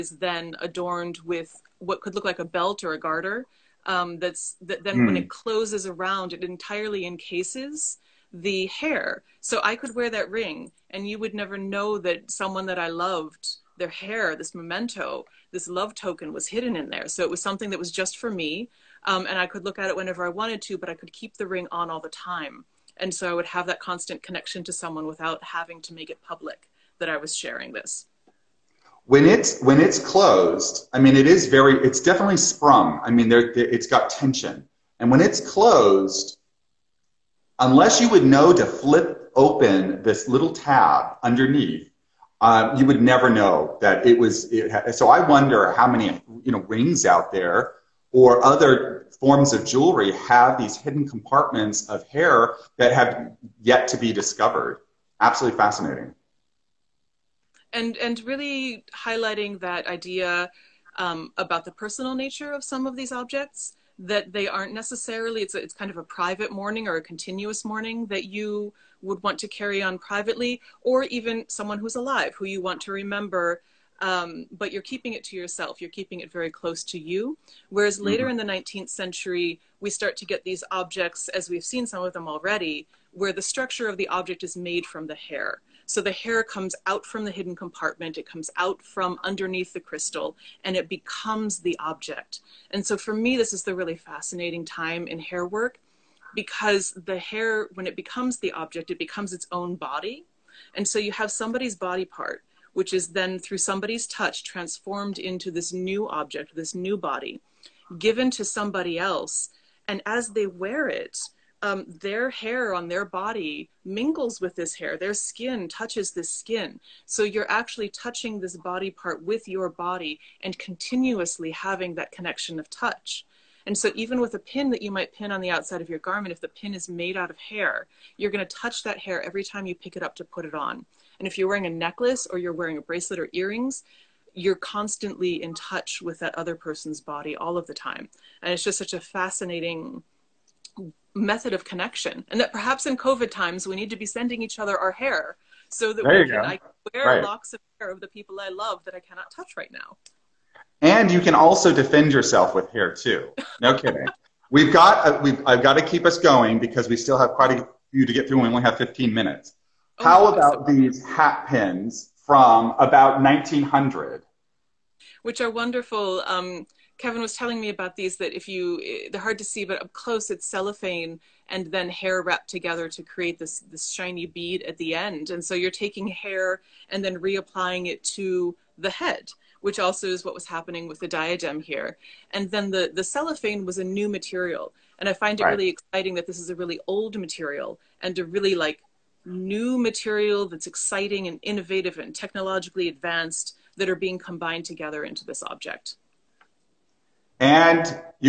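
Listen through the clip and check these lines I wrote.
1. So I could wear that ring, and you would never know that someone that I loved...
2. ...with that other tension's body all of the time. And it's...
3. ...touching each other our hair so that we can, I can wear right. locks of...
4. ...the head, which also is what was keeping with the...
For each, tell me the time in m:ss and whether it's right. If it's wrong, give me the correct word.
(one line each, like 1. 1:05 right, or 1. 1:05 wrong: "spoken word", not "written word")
1. 0:09 right
2. 2:16 wrong: "person", not "tension"
3. 2:24 wrong: "sending", not "touching"
4. 2:58 wrong: "happening", not "keeping".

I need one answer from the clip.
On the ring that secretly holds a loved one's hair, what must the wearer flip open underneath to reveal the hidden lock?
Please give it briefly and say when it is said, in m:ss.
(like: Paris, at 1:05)
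little tab, at 0:40.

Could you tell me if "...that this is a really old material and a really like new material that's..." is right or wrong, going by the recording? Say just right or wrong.
right.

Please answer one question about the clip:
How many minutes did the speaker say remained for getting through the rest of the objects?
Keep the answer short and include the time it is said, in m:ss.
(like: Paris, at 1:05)
15 minutes, at 2:38.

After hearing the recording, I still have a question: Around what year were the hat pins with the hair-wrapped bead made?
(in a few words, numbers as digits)
1900.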